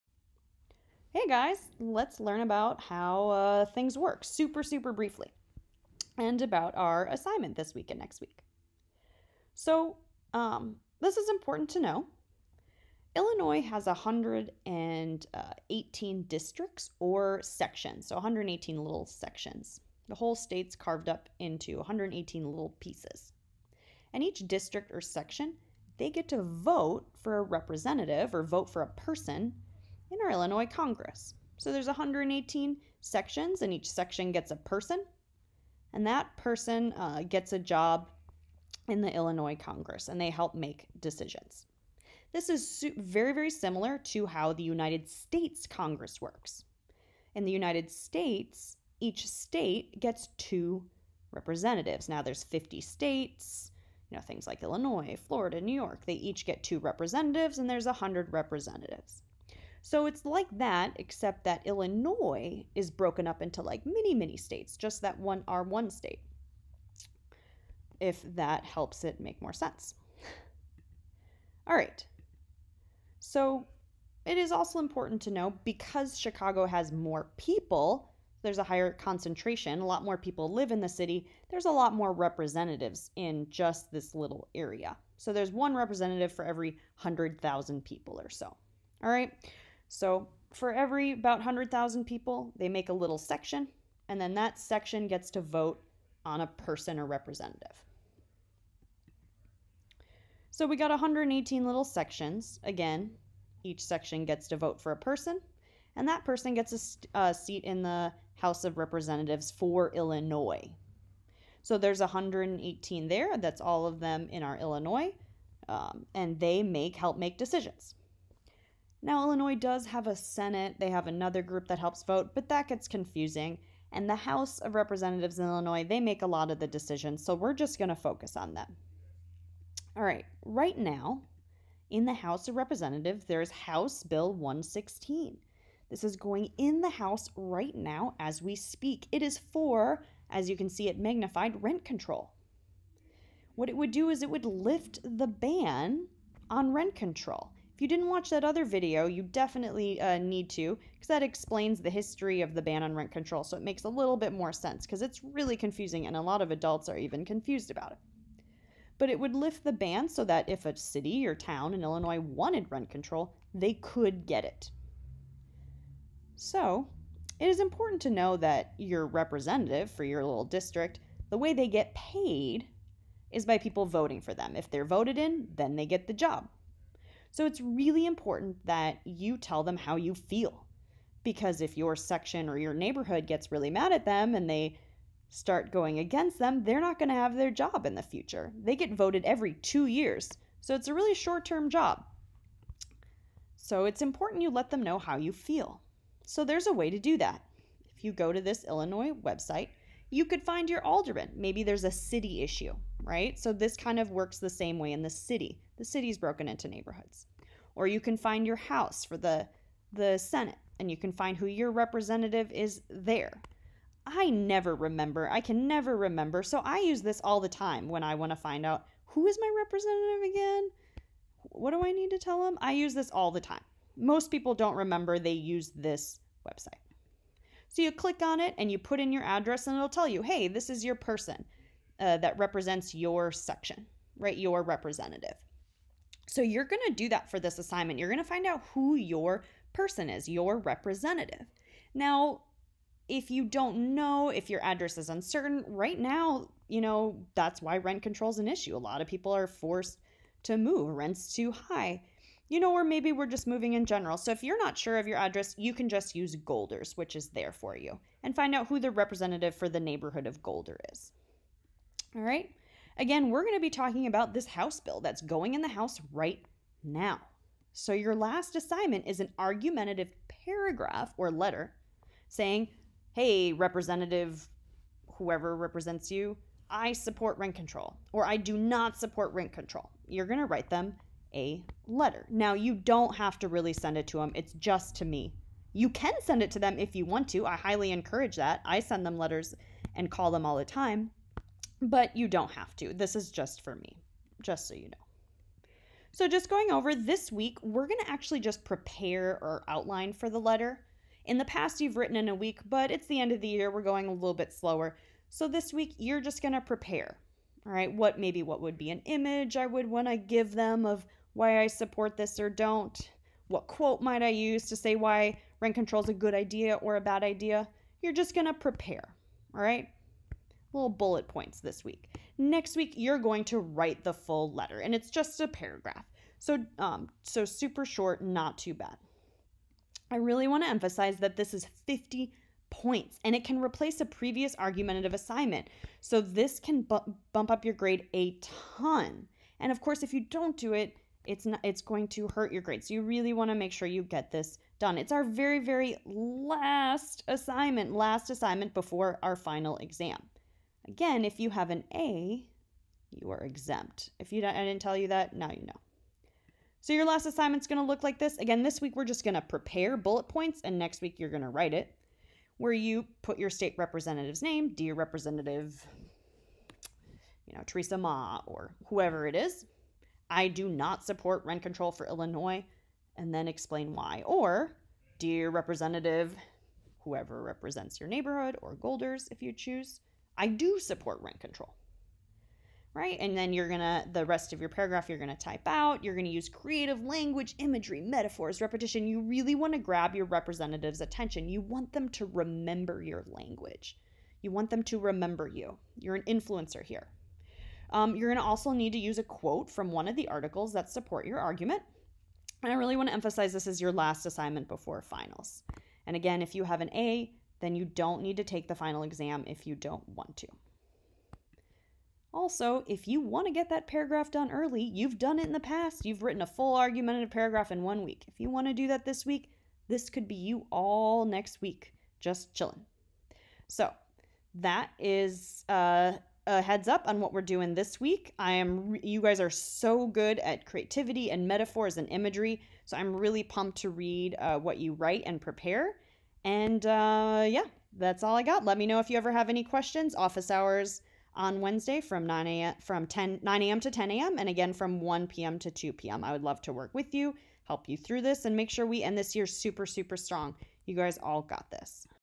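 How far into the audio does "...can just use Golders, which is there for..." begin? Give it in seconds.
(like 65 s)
255 s.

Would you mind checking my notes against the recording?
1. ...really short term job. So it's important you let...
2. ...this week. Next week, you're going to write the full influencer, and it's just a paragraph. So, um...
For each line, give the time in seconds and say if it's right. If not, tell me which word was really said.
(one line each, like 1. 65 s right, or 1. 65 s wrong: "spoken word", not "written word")
1. 190 s right
2. 321 s wrong: "letter", not "influencer".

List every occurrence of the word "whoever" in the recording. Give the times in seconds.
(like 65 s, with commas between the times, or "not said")
275 s, 368 s, 377 s.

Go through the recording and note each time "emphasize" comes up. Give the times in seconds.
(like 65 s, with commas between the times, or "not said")
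330 s, 403 s.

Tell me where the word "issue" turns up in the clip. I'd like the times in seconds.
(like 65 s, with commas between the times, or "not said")
202 s, 248 s.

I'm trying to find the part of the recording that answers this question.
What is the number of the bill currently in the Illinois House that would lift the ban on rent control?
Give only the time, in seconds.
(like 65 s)
133 s.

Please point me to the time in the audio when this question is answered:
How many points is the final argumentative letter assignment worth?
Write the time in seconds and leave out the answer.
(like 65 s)
331 s.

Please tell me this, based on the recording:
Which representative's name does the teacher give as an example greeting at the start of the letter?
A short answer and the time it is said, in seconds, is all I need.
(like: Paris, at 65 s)
Theresa Mah, at 367 s.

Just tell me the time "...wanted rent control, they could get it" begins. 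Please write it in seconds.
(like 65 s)
162 s.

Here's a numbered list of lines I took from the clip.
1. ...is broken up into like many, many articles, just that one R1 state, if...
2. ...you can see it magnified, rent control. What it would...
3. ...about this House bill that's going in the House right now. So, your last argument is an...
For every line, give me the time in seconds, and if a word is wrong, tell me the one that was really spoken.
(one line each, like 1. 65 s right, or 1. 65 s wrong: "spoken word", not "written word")
1. 62 s wrong: "states", not "articles"
2. 140 s right
3. 264 s wrong: "assignment", not "argument".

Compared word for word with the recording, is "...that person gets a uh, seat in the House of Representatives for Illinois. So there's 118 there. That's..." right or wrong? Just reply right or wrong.
right.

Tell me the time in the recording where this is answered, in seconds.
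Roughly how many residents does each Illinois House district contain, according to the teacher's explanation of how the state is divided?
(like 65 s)
85 s.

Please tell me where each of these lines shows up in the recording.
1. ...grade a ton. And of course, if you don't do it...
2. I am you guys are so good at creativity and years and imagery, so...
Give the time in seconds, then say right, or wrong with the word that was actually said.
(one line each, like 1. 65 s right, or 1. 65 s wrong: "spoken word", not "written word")
1. 337 s right
2. 428 s wrong: "metaphors", not "years".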